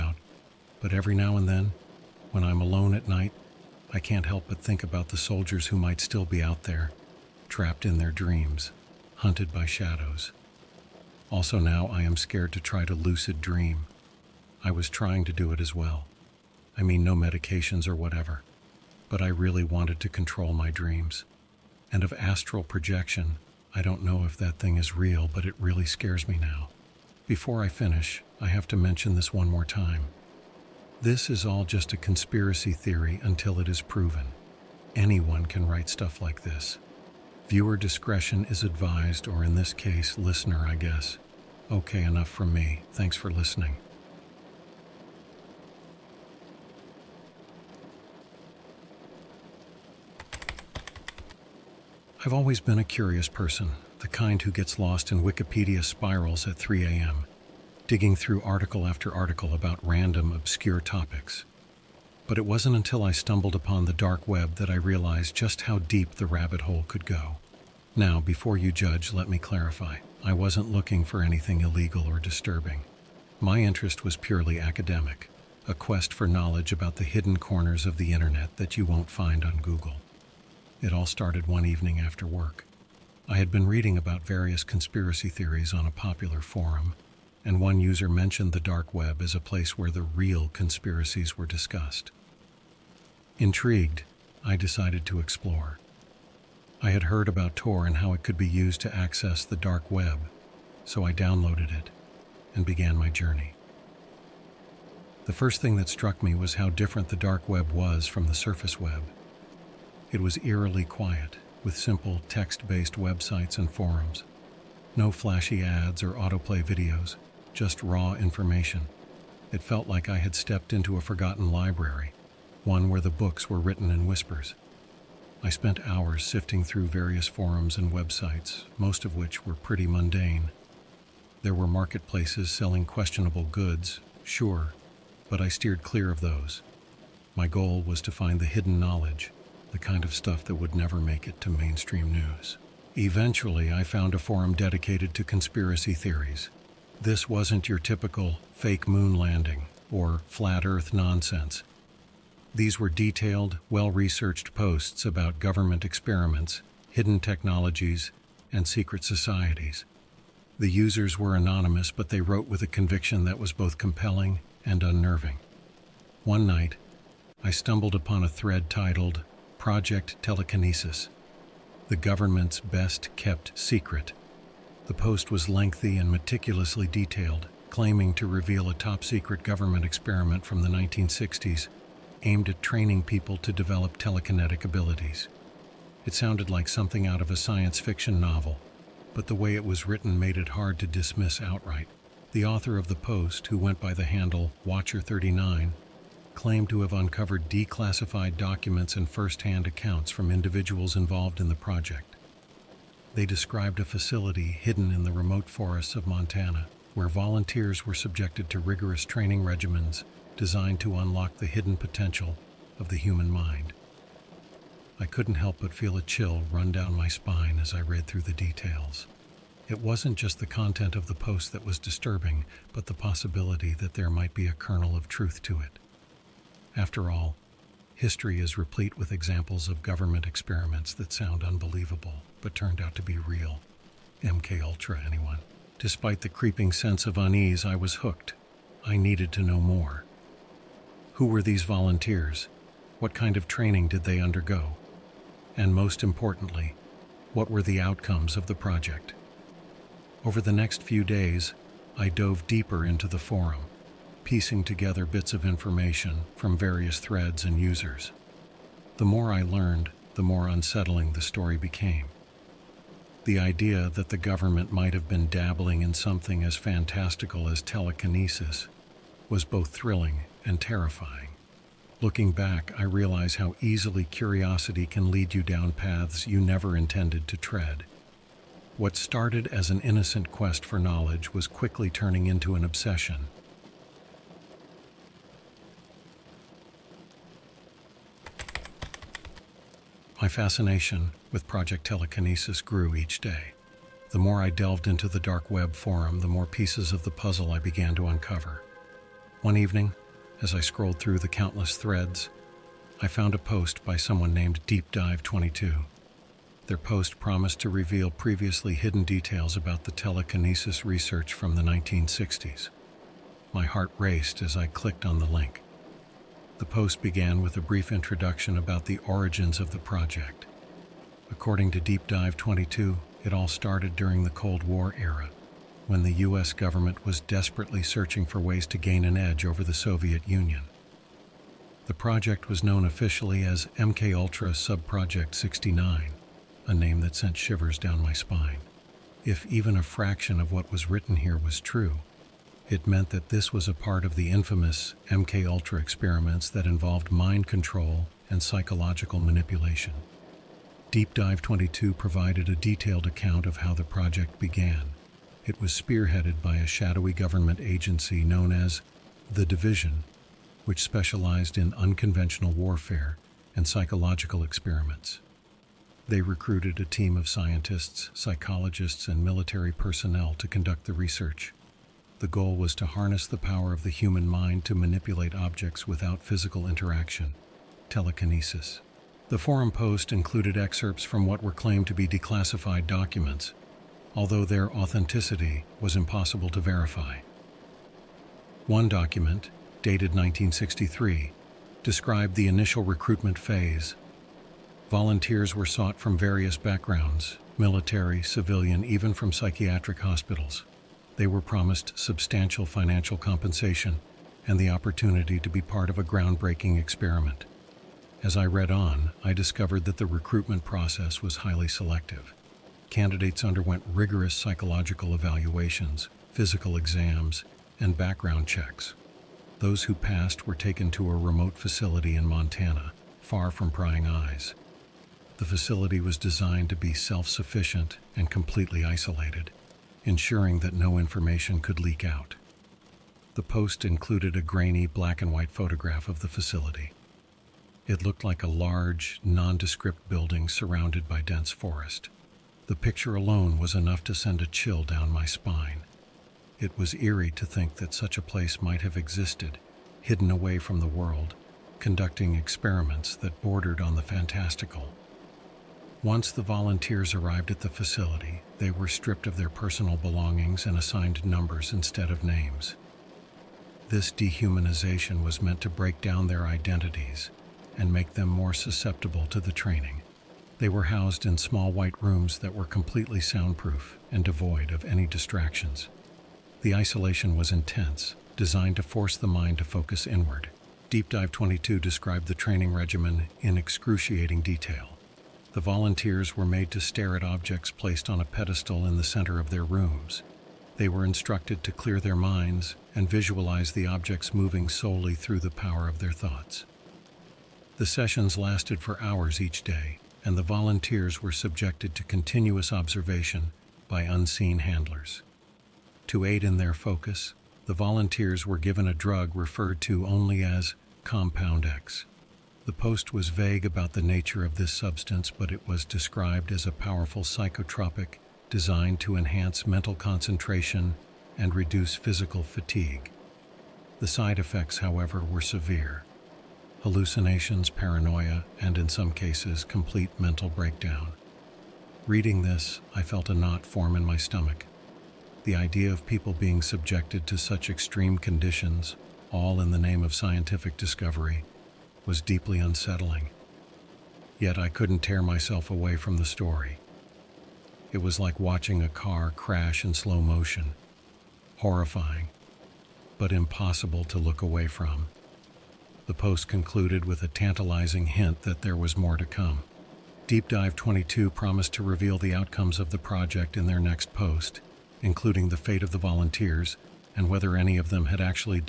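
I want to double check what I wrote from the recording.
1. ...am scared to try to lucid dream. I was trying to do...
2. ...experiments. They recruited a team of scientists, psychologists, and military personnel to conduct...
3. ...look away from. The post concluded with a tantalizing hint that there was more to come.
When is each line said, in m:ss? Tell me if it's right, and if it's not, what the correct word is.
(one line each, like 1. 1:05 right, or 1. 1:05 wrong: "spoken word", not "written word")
1. 0:12 right
2. 6:04 right
3. 9:14 right.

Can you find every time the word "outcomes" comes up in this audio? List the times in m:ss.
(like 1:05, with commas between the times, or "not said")
4:07, 9:22.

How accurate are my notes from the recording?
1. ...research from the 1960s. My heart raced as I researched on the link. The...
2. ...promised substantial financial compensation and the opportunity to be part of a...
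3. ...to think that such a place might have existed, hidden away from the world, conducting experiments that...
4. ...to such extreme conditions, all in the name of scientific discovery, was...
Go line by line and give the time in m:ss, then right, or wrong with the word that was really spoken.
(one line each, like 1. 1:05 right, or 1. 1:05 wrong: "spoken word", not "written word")
1. 5:10 wrong: "clicked", not "researched"
2. 6:41 right
3. 7:27 right
4. 8:57 right.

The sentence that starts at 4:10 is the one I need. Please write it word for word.
Over the next few days, I dove deeper into the forum, piecing together bits of information from various threads and users.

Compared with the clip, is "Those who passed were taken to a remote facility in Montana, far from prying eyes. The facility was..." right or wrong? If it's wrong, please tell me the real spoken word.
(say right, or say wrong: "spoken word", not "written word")
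right.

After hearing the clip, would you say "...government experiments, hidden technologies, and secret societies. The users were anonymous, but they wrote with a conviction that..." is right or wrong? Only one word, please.
right.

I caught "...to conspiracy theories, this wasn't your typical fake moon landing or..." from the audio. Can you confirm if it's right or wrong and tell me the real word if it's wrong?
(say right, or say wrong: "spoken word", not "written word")
right.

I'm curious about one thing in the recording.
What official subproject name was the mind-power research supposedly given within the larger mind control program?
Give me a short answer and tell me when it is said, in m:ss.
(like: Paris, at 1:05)
MKUltra Subproject 69, at 5:33.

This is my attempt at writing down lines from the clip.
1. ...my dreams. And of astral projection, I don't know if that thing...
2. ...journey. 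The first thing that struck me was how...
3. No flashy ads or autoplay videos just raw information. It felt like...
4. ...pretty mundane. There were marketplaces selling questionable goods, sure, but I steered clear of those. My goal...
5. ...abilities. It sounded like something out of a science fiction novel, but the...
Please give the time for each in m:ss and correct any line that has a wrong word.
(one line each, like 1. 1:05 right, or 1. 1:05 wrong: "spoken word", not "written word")
1. 0:20 right
2. 1:43 right
3. 1:54 right
4. 2:09 right
5. 3:04 right.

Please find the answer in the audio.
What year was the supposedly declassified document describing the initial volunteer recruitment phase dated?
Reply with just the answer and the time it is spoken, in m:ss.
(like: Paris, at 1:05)
1963, at 6:30.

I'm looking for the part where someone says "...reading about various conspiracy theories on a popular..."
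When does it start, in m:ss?
1:23.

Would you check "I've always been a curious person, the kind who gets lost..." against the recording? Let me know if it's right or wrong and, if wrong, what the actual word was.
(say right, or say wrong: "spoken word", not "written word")
right.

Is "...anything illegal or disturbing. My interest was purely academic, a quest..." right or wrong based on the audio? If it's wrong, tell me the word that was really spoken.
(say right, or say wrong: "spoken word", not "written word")
right.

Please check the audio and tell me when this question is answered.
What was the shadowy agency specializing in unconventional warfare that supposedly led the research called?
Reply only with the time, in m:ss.
5:59.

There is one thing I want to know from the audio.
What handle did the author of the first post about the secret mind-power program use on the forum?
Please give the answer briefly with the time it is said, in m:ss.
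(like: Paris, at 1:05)
Watcher39, at 3:14.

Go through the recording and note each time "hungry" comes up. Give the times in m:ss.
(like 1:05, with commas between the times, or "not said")
not said.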